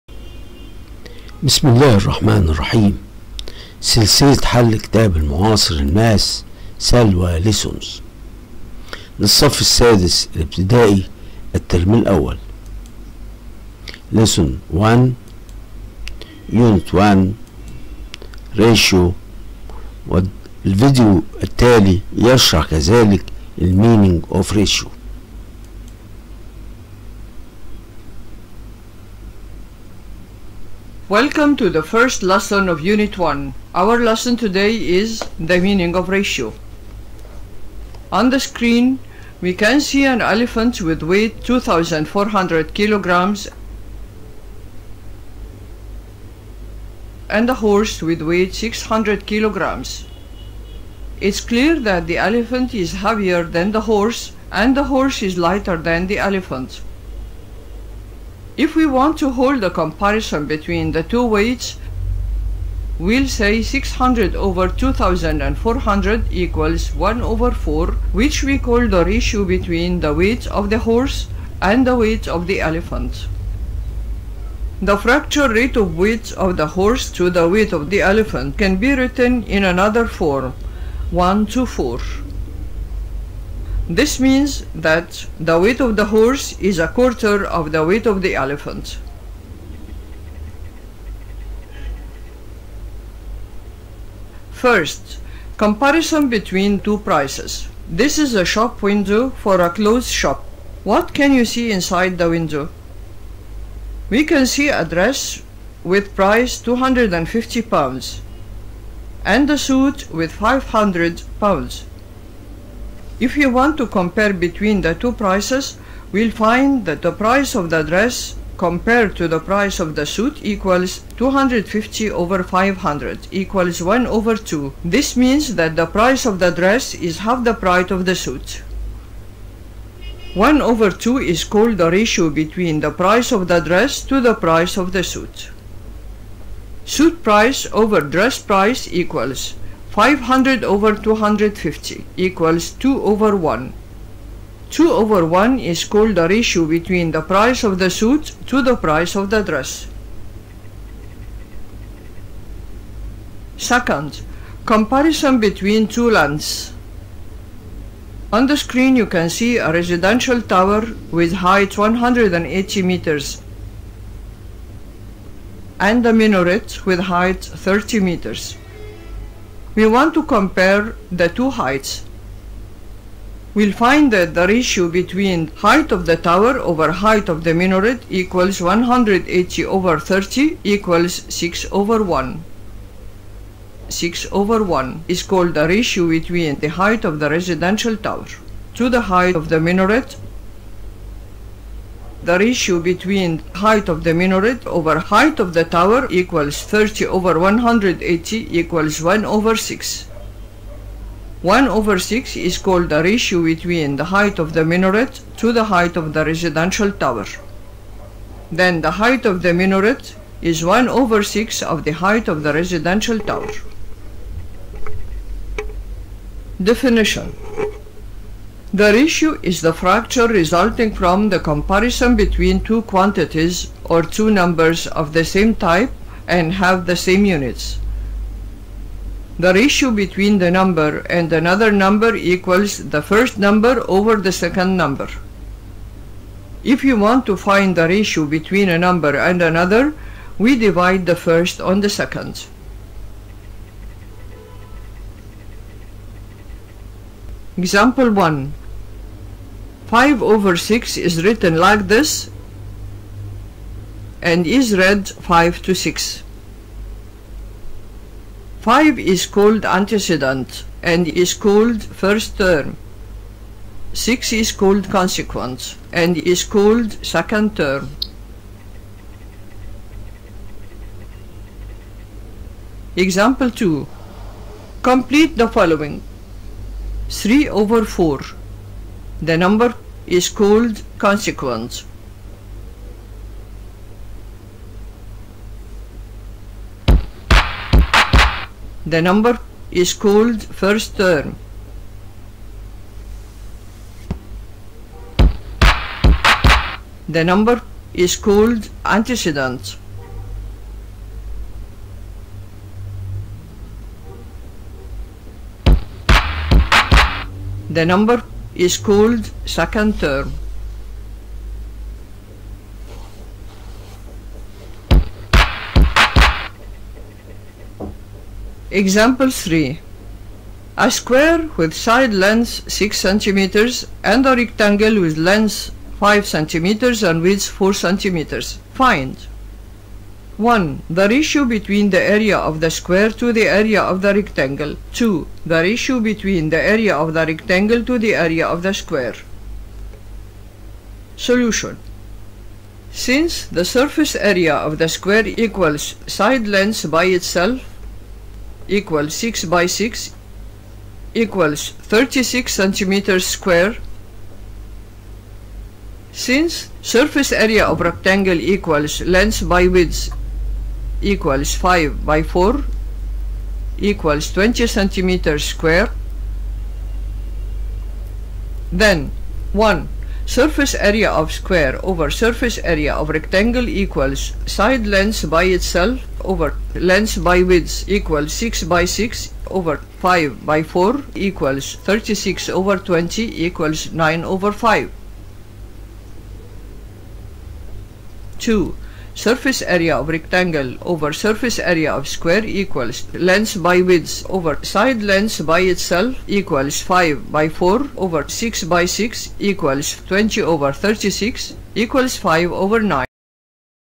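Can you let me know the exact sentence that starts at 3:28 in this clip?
Then the height of the minaret is 1 over 6 of the height of the residential tower.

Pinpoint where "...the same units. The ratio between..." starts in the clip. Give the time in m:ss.
3:46.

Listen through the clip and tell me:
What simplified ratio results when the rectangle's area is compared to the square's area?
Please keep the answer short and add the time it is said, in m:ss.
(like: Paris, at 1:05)
5 over 9, at 6:42.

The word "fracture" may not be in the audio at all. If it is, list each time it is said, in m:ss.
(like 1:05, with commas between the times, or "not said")
1:14, 3:39.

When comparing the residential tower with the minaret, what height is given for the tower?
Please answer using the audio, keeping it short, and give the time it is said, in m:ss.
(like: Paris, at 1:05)
180 meters, at 2:41.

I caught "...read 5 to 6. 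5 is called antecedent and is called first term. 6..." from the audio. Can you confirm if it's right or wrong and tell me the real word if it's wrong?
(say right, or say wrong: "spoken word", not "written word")
right.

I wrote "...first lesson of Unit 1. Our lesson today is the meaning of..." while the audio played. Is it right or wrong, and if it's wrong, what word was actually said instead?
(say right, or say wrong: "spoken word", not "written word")
right.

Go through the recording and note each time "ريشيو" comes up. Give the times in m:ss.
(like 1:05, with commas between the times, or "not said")
0:18, 0:24.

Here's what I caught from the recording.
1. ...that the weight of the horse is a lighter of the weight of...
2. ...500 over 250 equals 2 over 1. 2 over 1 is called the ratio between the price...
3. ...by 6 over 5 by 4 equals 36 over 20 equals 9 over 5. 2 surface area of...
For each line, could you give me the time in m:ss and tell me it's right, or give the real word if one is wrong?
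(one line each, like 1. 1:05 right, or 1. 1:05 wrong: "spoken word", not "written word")
1. 1:24 wrong: "quarter", not "lighter"
2. 2:19 right
3. 6:18 right.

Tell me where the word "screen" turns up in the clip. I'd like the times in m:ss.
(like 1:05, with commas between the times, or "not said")
0:38, 2:38.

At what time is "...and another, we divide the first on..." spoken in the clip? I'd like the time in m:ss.
3:59.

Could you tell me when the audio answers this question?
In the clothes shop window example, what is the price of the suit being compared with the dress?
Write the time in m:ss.
1:50.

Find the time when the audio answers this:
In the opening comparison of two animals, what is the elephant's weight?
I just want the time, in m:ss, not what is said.
0:41.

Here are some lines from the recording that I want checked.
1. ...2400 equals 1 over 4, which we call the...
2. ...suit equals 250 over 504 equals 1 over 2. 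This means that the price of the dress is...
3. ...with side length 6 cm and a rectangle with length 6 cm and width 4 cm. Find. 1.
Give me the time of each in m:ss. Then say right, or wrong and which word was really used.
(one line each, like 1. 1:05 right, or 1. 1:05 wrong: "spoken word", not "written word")
1. 1:04 right
2. 2:00 wrong: "500", not "504"
3. 5:21 wrong: "5", not "6".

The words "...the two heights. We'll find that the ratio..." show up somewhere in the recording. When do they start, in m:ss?
2:51.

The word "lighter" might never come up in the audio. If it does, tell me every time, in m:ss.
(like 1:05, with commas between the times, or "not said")
0:55.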